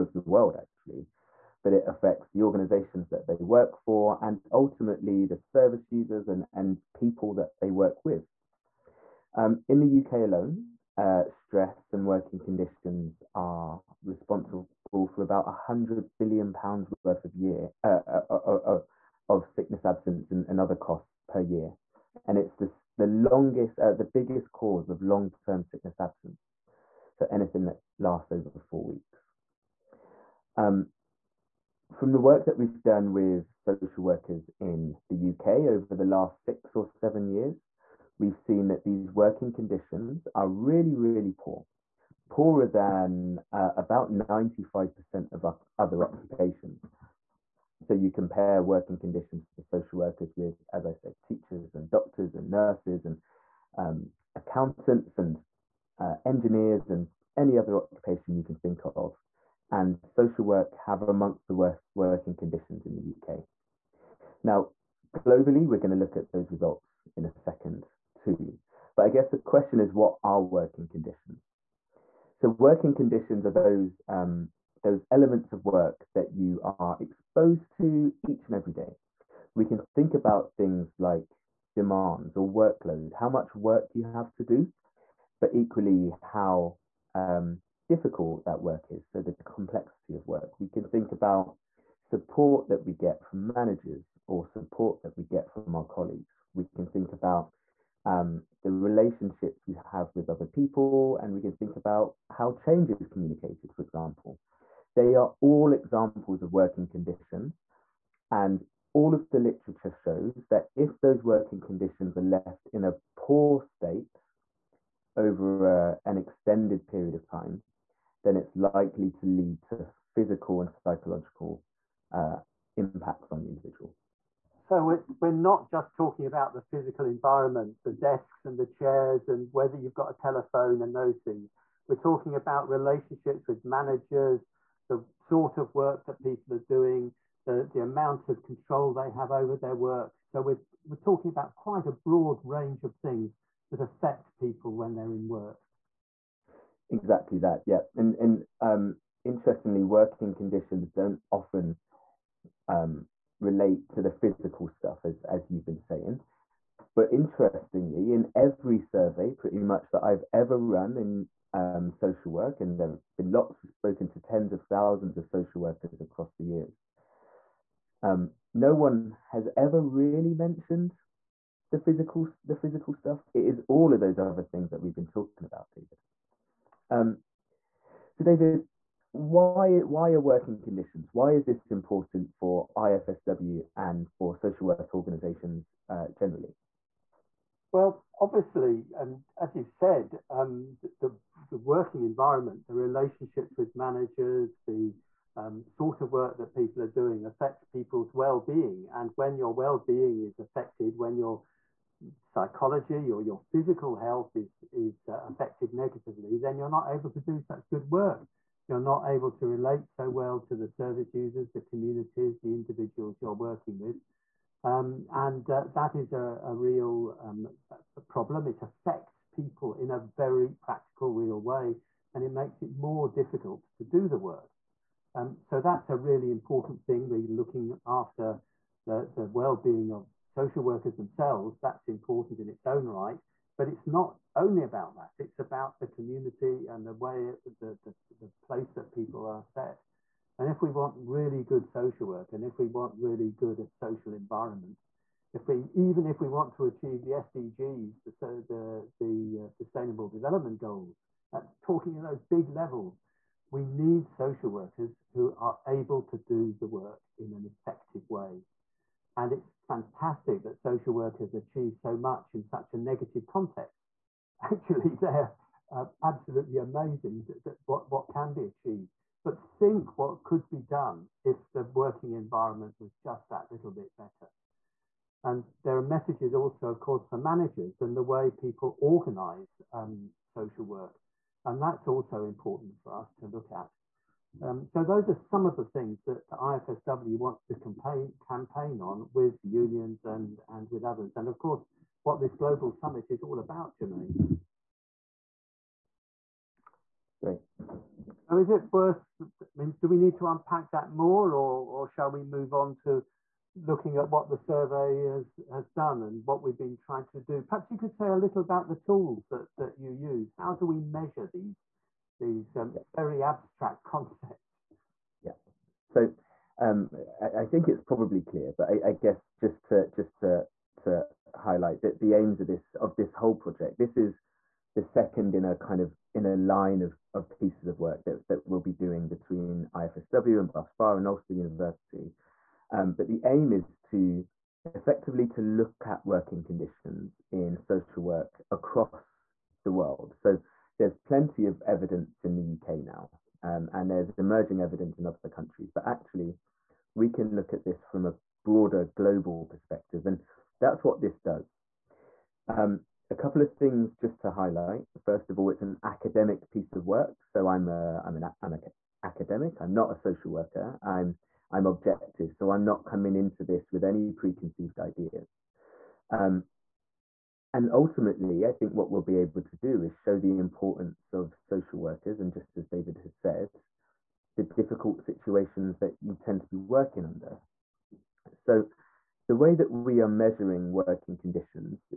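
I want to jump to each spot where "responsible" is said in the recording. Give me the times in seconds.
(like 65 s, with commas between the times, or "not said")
14 s.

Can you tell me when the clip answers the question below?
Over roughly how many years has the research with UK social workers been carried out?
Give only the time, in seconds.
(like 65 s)
36 s.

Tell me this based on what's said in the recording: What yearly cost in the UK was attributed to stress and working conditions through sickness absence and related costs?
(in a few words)
100 billion pounds.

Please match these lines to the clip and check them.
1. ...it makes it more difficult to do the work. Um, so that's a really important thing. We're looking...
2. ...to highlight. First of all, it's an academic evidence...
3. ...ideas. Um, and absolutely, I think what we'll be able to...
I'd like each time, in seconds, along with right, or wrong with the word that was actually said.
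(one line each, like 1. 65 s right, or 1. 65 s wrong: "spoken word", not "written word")
1. 222 s right
2. 354 s wrong: "piece", not "evidence"
3. 364 s wrong: "ultimately", not "absolutely".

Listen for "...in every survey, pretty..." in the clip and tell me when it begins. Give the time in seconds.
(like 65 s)
158 s.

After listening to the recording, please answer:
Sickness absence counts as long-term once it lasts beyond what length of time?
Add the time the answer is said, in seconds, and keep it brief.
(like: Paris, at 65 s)
four weeks, at 28 s.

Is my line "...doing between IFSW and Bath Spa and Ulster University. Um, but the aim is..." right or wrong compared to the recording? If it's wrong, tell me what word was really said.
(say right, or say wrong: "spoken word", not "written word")
right.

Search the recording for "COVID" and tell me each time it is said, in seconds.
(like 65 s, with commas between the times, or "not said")
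not said.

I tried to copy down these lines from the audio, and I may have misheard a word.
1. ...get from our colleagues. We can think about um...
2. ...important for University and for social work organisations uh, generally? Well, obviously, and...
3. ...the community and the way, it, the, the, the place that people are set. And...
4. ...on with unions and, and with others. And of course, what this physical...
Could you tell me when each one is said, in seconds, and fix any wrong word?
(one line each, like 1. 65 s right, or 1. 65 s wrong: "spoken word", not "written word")
1. 95 s right
2. 181 s wrong: "IFSW", not "University"
3. 235 s right
4. 288 s wrong: "global", not "physical".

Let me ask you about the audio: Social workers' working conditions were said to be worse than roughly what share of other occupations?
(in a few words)
95%.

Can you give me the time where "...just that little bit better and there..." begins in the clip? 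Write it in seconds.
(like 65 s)
272 s.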